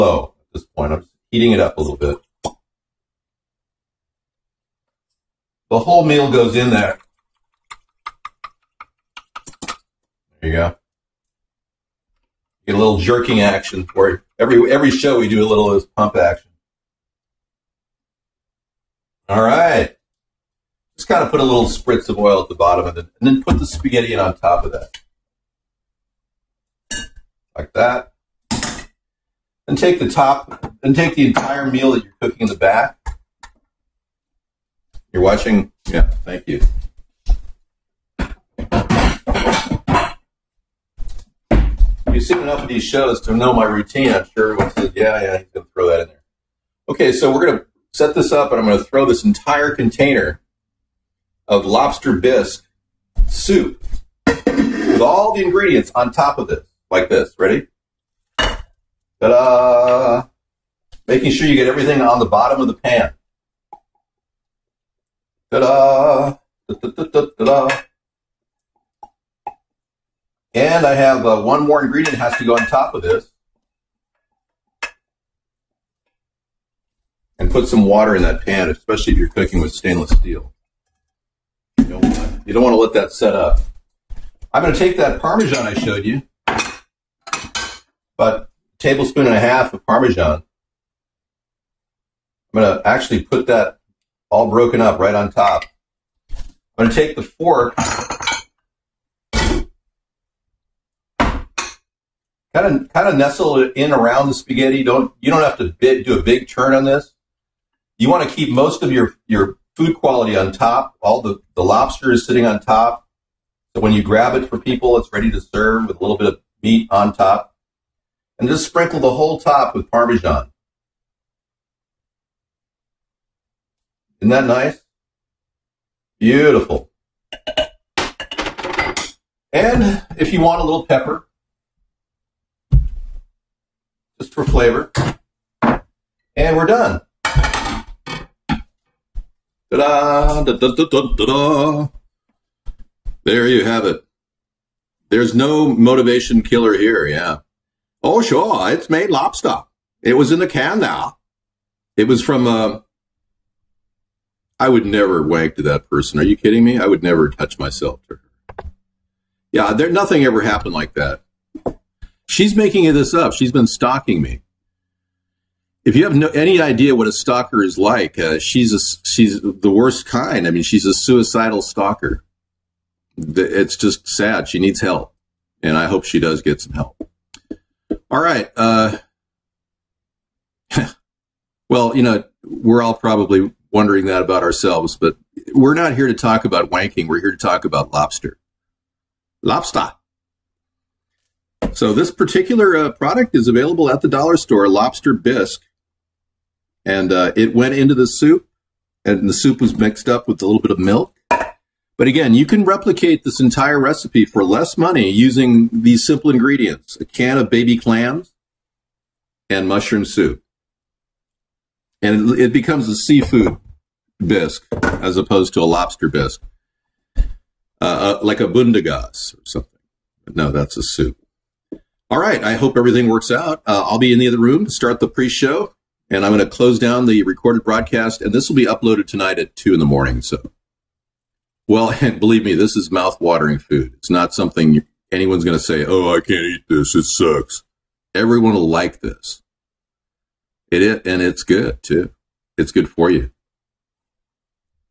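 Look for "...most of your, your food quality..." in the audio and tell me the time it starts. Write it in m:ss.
1:48.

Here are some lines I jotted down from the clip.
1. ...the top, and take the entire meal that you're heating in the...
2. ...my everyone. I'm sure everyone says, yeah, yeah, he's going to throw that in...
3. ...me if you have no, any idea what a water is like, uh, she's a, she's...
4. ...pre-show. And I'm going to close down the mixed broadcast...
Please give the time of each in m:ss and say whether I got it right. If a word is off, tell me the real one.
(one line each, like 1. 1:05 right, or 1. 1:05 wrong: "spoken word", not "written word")
1. 0:29 wrong: "cooking", not "heating"
2. 0:43 wrong: "routine", not "everyone"
3. 2:44 wrong: "stalker", not "water"
4. 3:45 wrong: "recorded", not "mixed".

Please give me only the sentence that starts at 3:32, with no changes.
And it, it becomes a seafood bisque as opposed to a lobster bisque, uh, uh, like a bundagas or something.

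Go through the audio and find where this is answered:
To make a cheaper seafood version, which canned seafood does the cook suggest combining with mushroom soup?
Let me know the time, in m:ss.
3:27.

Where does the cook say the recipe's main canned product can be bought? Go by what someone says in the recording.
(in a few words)
The dollar store.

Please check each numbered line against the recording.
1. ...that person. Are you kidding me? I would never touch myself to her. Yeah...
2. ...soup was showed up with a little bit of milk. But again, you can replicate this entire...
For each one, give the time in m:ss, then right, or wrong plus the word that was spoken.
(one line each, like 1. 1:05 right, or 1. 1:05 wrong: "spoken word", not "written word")
1. 2:35 right
2. 3:19 wrong: "mixed", not "showed".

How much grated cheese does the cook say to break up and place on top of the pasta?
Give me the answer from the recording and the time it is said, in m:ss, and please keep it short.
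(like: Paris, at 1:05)
1.5 tablespoons, at 1:28.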